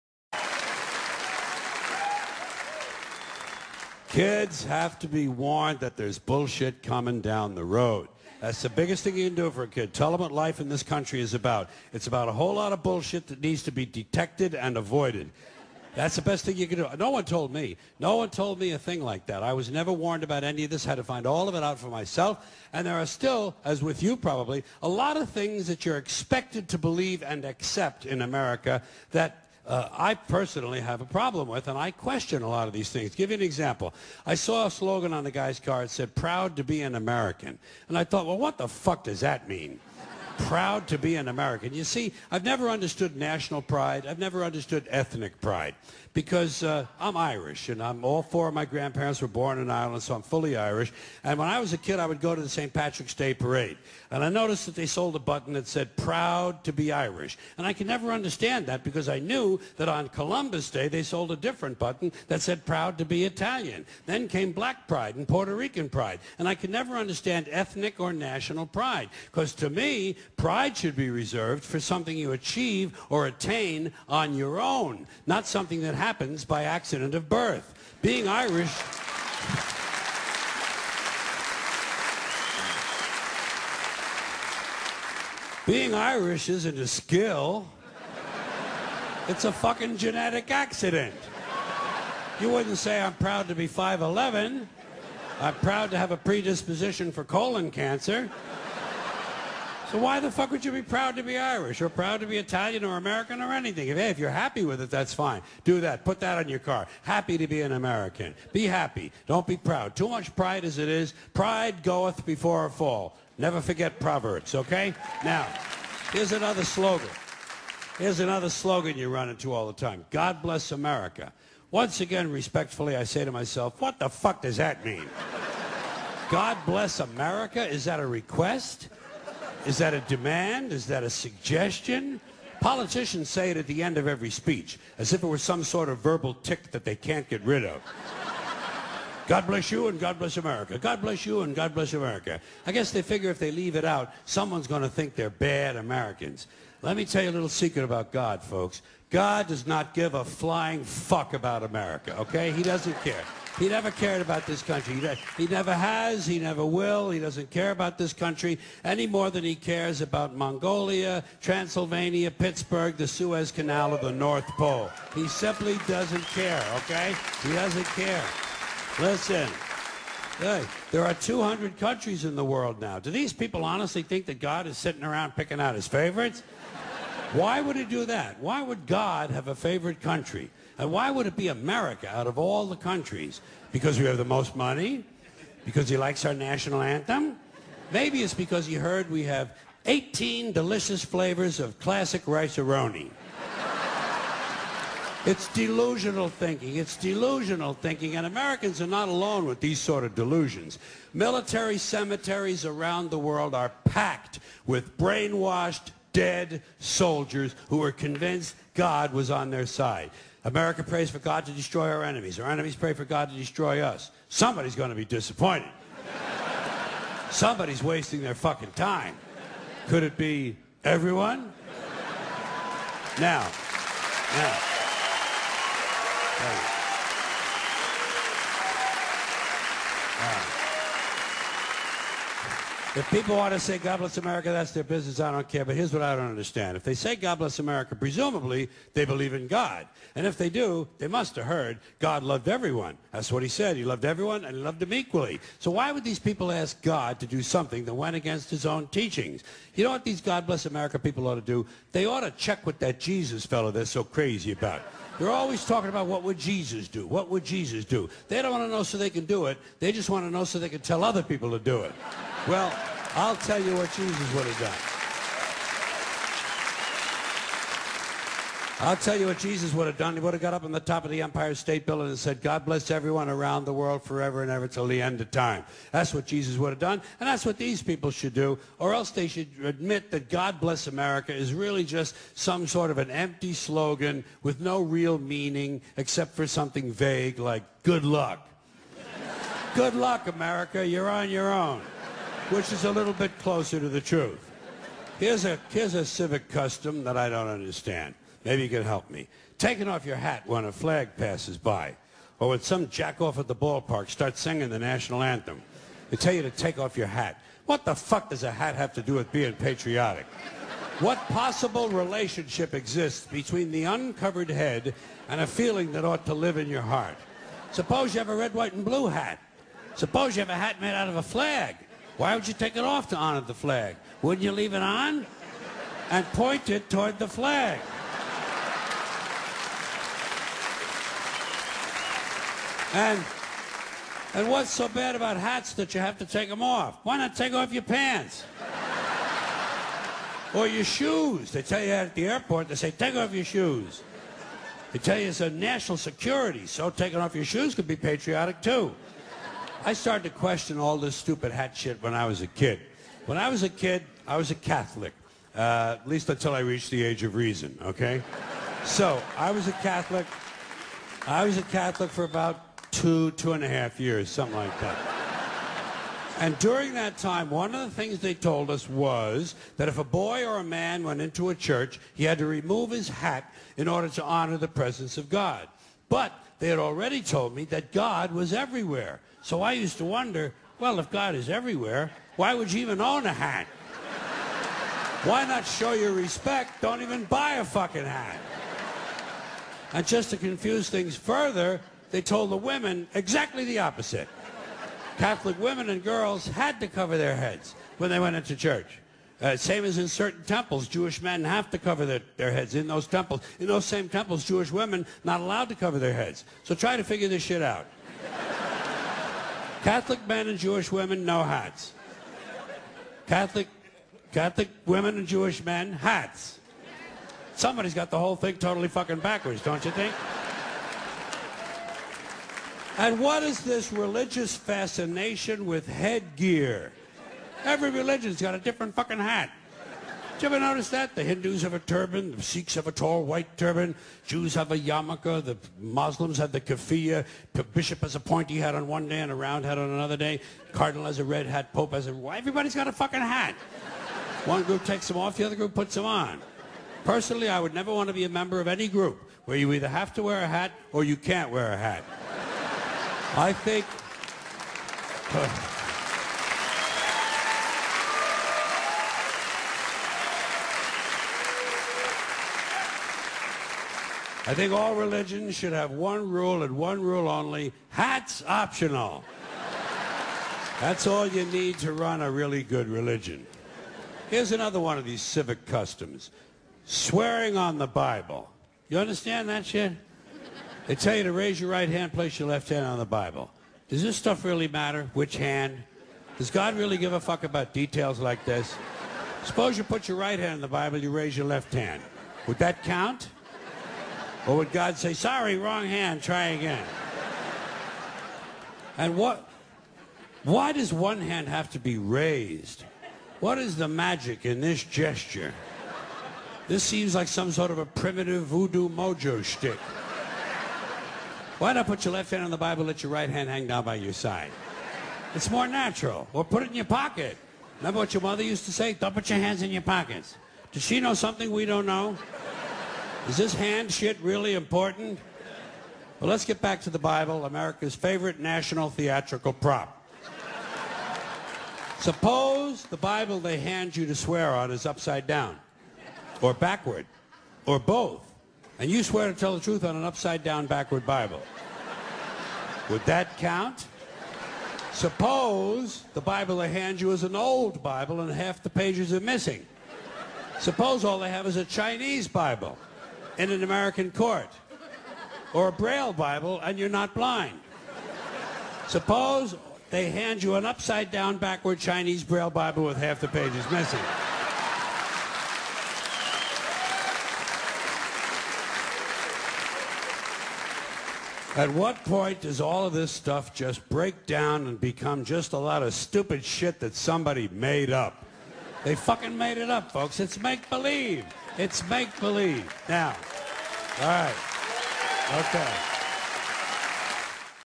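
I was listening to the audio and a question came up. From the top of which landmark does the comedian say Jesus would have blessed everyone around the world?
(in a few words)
Empire State Building.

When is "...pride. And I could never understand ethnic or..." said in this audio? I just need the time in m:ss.
1:05.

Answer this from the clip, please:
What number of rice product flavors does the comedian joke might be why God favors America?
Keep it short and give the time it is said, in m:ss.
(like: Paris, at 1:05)
18, at 3:09.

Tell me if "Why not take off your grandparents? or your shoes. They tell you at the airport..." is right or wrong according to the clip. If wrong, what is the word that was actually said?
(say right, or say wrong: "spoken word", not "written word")
wrong: "pants", not "grandparents".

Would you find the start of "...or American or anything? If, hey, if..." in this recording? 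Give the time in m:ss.
1:42.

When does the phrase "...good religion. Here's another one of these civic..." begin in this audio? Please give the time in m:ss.
7:52.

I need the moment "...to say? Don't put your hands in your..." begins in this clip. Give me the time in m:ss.
8:38.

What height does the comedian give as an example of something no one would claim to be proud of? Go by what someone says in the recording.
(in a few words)
5'11".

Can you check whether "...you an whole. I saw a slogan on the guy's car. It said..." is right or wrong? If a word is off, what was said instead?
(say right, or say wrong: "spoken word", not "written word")
wrong: "example", not "whole".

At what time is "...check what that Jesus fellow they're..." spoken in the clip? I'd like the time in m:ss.
4:12.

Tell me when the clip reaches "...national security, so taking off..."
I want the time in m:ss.
5:45.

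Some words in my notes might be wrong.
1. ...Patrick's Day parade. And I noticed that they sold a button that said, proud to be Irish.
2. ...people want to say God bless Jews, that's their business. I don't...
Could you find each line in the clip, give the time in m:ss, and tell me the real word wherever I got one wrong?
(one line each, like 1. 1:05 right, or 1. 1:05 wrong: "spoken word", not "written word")
1. 0:52 right
2. 3:53 wrong: "America", not "Jews".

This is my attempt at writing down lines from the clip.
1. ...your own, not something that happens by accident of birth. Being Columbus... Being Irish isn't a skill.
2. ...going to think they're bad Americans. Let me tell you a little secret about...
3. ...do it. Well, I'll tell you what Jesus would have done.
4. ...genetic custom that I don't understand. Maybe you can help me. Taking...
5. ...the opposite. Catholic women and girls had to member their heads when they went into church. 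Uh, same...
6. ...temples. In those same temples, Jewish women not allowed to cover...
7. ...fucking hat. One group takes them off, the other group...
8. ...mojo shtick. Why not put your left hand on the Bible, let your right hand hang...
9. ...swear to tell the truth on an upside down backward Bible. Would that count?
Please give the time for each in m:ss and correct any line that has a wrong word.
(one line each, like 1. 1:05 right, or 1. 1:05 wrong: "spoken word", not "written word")
1. 1:14 wrong: "Irish", not "Columbus"
2. 2:24 right
3. 4:21 right
4. 4:56 wrong: "civic", not "genetic"
5. 6:33 wrong: "cover", not "member"
6. 6:43 right
7. 7:22 right
8. 8:28 right
9. 8:59 right.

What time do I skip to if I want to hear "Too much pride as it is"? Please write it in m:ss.
1:49.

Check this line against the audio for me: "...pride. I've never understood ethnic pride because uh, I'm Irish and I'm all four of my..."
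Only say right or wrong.
right.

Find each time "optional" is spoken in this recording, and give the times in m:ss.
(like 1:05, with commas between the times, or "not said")
7:48.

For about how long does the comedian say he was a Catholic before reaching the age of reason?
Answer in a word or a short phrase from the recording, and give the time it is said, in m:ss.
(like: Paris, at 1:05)
2 and a half years, at 6:03.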